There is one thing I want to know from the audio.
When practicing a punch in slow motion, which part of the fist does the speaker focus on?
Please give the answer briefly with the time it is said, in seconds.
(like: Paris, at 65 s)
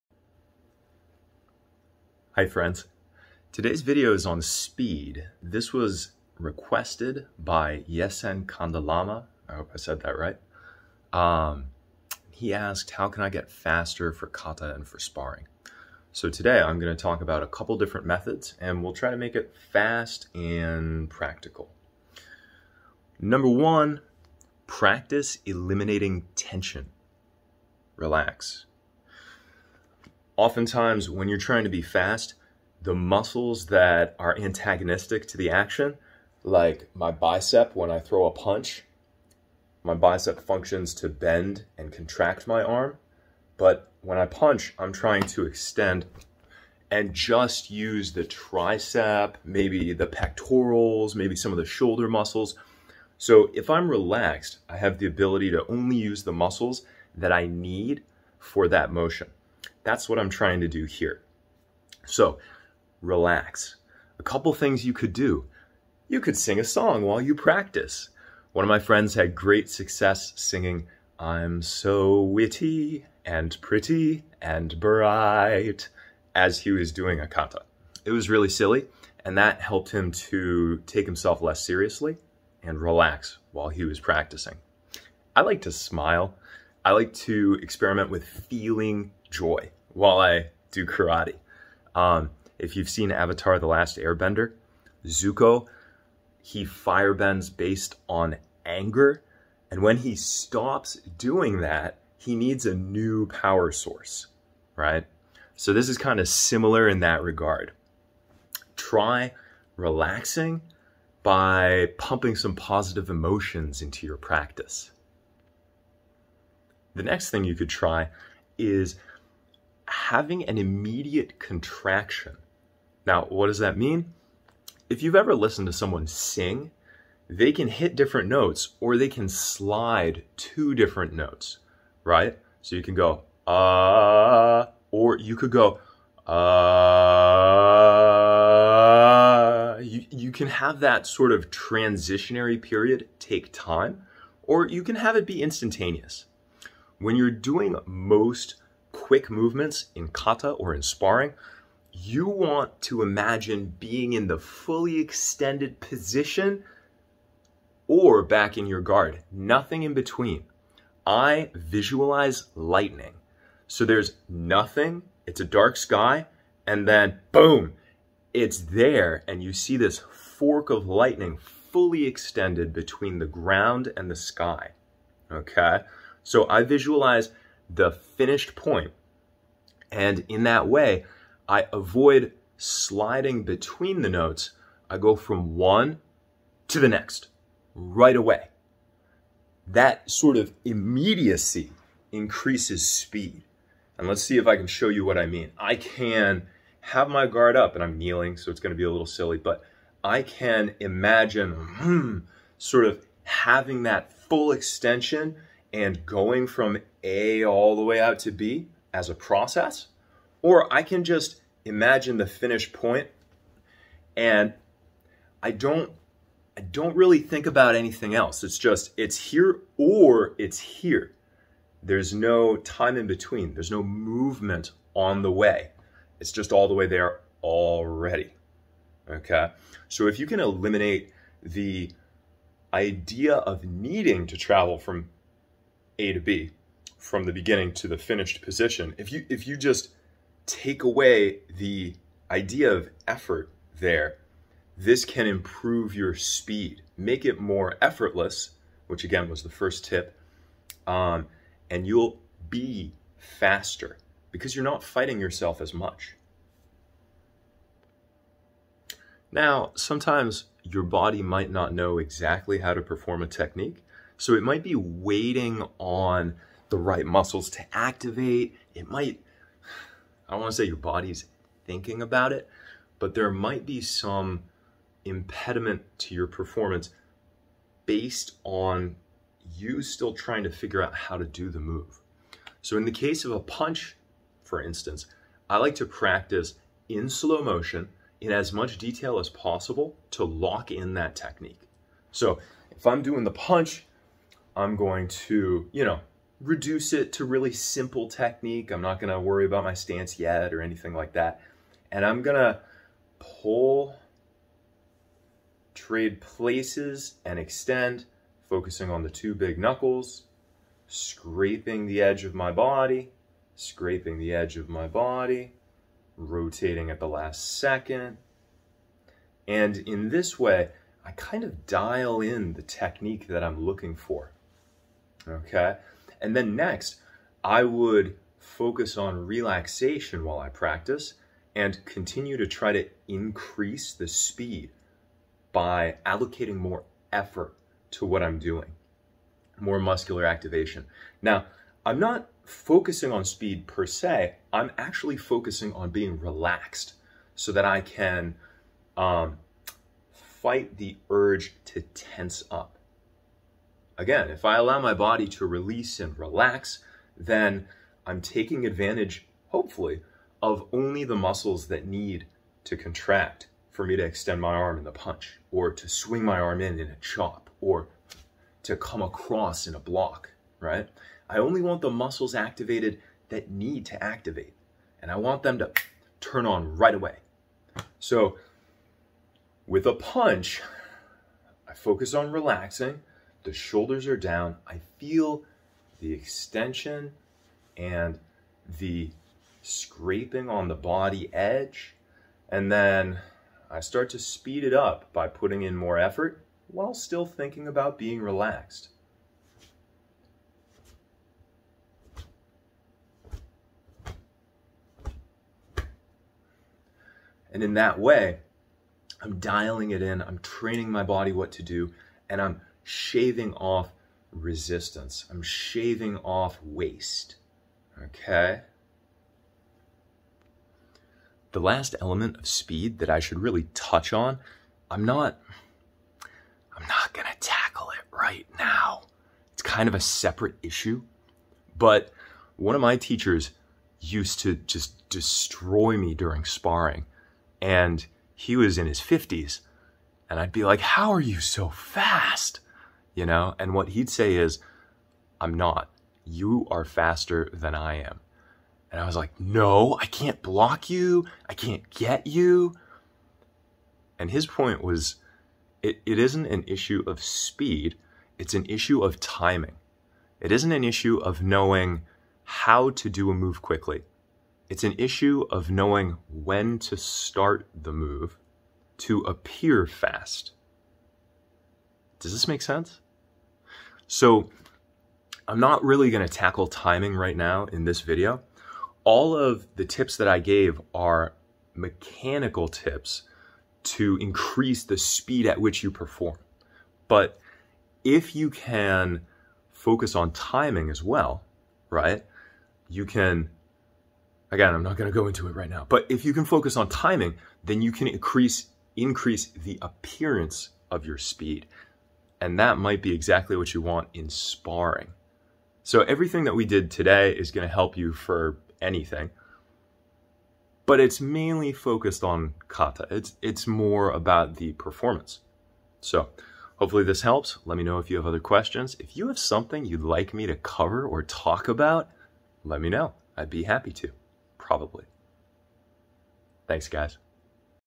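the two big knuckles, at 309 s.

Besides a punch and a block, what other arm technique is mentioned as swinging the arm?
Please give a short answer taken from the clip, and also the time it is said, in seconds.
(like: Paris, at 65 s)
chop, at 366 s.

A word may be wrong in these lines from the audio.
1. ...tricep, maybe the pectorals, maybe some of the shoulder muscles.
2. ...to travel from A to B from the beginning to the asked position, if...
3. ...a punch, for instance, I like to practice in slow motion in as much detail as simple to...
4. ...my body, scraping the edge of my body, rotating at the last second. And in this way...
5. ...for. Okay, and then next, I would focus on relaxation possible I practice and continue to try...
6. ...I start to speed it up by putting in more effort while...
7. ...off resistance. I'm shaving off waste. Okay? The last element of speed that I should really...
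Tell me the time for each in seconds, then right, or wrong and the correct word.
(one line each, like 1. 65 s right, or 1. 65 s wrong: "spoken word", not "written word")
1. 48 s right
2. 234 s wrong: "finished", not "asked"
3. 283 s wrong: "possible", not "simple"
4. 312 s right
5. 323 s wrong: "while", not "possible"
6. 393 s right
7. 413 s right.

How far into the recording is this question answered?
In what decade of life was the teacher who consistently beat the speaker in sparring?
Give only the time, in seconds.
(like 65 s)
438 s.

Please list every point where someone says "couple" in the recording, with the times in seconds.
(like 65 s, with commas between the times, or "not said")
17 s, 64 s.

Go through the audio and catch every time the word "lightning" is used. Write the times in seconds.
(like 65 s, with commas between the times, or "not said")
162 s, 170 s.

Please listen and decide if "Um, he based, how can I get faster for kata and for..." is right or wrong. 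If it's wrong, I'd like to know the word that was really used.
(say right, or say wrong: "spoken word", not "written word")
wrong: "asked", not "based".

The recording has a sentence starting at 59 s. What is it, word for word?
That's what I'm trying to do here.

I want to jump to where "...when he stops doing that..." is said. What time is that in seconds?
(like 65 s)
99 s.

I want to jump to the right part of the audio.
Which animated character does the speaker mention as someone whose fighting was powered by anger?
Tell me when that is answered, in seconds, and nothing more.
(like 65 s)
95 s.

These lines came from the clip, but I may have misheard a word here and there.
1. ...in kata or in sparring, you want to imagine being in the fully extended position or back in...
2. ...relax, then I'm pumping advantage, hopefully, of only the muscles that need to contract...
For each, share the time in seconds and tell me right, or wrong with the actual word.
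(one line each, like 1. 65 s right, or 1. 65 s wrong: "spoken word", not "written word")
1. 149 s right
2. 356 s wrong: "taking", not "pumping".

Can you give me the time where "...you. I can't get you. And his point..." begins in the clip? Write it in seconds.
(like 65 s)
450 s.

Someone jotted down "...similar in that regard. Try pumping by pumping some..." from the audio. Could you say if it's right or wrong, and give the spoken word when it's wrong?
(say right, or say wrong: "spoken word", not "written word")
wrong: "relaxing", not "pumping".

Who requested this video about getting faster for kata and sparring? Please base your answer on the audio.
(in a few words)
Yesen Kandalama.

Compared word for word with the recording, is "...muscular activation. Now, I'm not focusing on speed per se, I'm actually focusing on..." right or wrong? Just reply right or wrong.
right.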